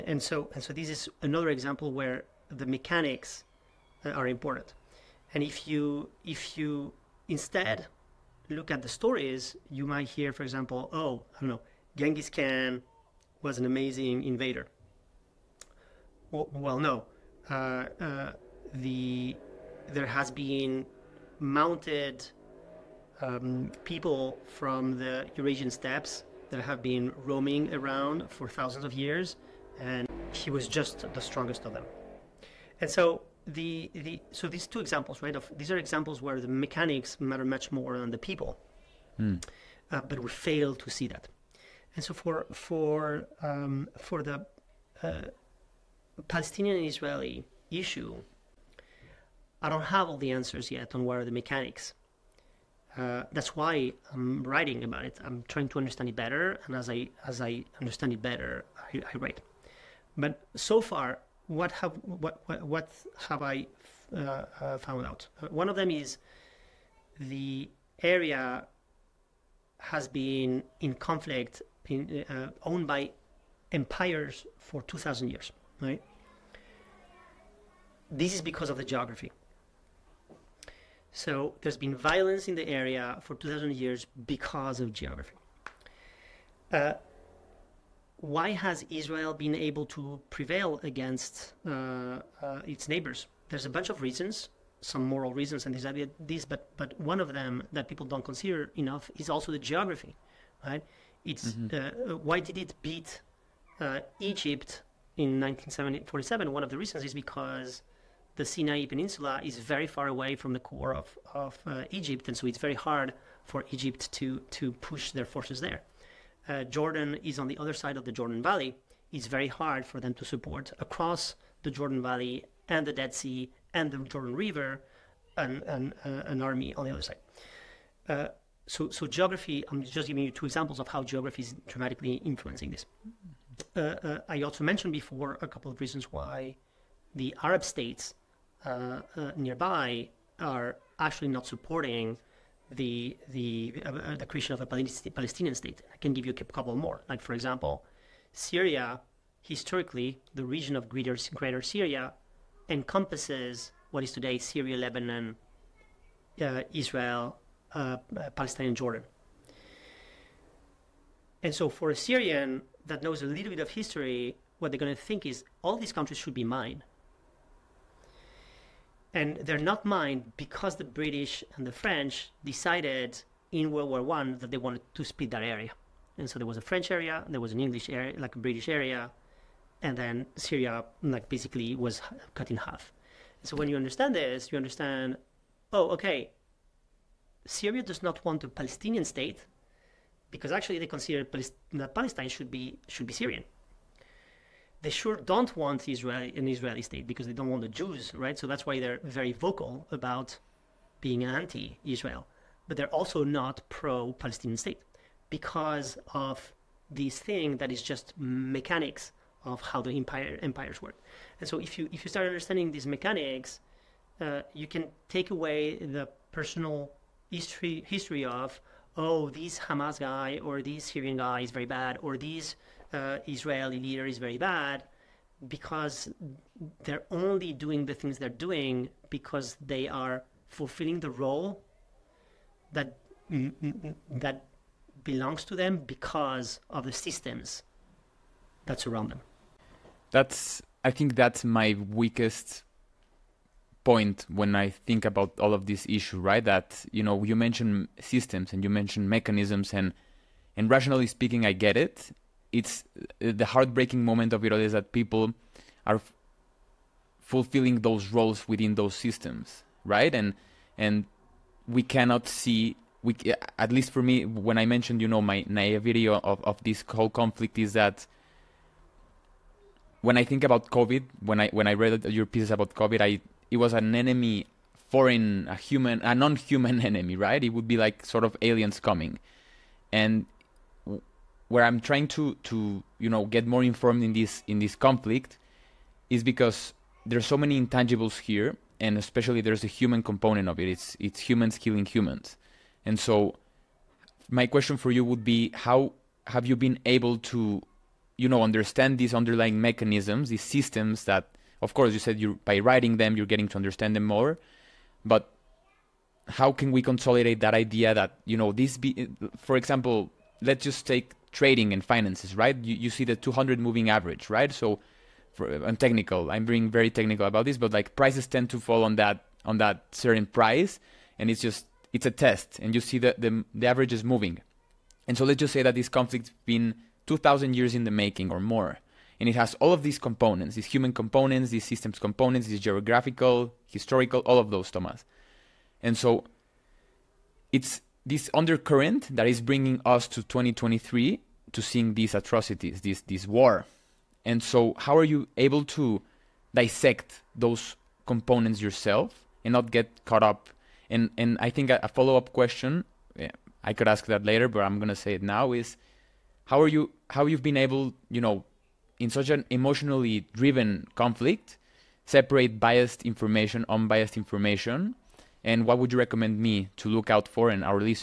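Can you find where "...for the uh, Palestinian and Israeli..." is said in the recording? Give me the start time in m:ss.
0:43.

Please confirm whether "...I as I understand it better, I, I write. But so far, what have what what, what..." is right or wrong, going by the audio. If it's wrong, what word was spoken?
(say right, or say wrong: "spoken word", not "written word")
right.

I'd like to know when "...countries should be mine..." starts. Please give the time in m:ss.
2:45.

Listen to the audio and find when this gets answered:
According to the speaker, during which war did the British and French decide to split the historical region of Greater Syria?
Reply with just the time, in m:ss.
2:53.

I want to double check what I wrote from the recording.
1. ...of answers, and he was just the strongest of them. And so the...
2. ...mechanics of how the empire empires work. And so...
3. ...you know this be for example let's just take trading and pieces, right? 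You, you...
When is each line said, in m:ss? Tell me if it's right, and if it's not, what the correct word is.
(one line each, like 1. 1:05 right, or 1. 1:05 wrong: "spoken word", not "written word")
1. 0:28 wrong: "years", not "answers"
2. 3:28 right
3. 5:08 wrong: "finances", not "pieces".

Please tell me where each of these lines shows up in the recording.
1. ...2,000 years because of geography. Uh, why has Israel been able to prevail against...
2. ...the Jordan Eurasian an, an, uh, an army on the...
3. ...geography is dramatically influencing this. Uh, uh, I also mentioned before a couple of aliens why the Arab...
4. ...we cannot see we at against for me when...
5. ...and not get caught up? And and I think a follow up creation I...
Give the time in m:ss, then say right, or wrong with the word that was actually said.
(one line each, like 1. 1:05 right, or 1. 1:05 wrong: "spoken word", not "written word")
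1. 1:23 right
2. 2:03 wrong: "River", not "Eurasian"
3. 2:11 wrong: "reasons", not "aliens"
4. 4:21 wrong: "least", not "against"
5. 5:49 wrong: "question", not "creation".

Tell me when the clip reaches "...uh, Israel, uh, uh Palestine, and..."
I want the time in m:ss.
2:36.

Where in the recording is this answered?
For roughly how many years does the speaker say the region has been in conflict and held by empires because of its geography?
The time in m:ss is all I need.
1:14.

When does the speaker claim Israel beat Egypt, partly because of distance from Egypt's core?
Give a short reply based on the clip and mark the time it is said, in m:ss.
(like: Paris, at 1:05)
1947, at 1:45.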